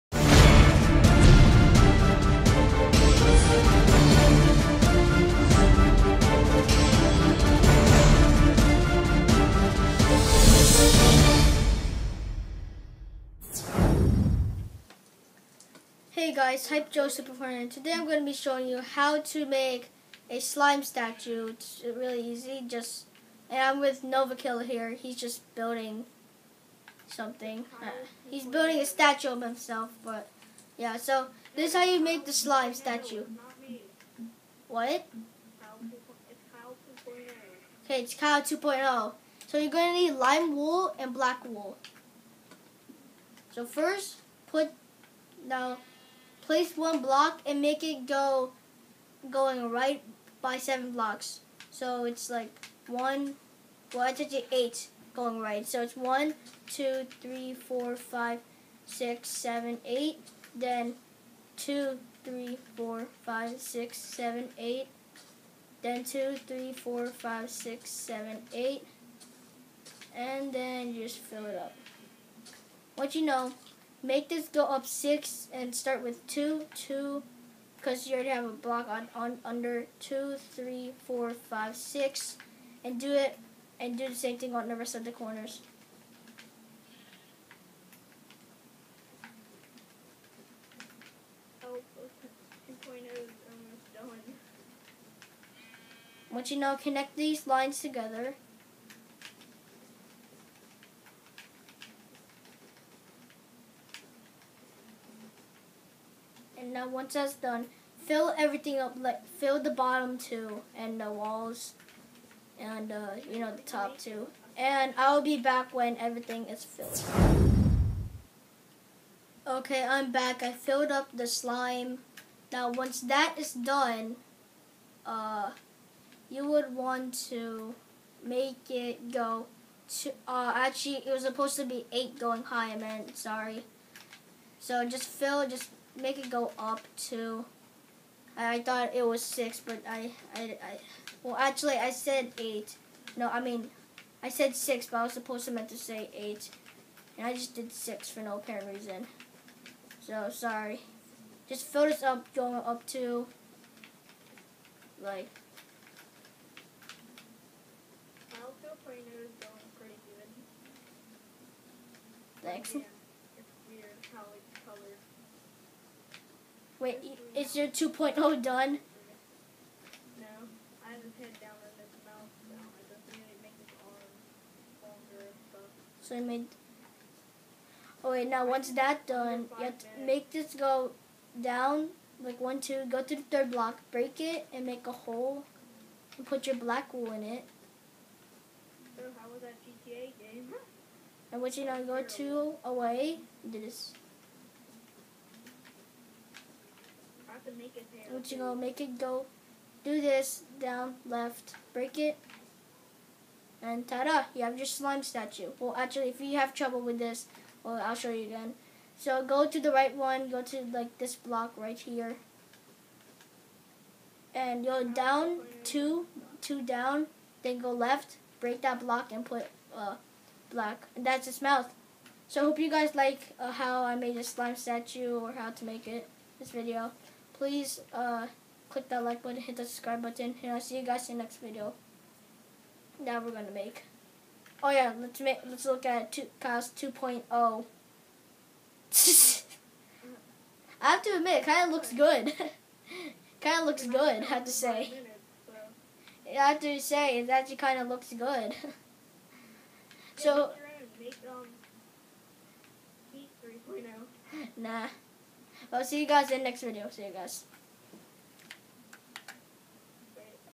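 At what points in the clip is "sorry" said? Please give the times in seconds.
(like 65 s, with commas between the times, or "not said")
133 s, 150 s.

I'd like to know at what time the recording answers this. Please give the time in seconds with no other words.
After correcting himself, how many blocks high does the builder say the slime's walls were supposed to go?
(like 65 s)
131 s.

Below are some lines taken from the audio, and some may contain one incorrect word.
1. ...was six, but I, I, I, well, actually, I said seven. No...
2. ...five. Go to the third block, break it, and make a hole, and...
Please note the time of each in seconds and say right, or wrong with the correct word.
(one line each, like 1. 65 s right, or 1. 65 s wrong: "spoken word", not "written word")
1. 139 s wrong: "eight", not "seven"
2. 182 s wrong: "two", not "five".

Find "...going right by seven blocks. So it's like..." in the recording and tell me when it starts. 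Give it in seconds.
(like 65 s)
49 s.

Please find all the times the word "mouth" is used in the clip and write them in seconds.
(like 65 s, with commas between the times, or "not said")
172 s, 221 s.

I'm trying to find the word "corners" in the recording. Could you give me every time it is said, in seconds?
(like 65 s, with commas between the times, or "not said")
85 s.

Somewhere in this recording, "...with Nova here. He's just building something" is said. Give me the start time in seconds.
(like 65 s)
23 s.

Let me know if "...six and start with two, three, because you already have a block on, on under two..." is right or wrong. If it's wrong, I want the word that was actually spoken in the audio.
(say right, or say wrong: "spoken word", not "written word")
wrong: "two", not "three".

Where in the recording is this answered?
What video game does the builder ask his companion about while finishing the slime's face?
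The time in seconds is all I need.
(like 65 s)
189 s.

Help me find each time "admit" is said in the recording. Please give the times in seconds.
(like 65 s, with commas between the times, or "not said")
241 s.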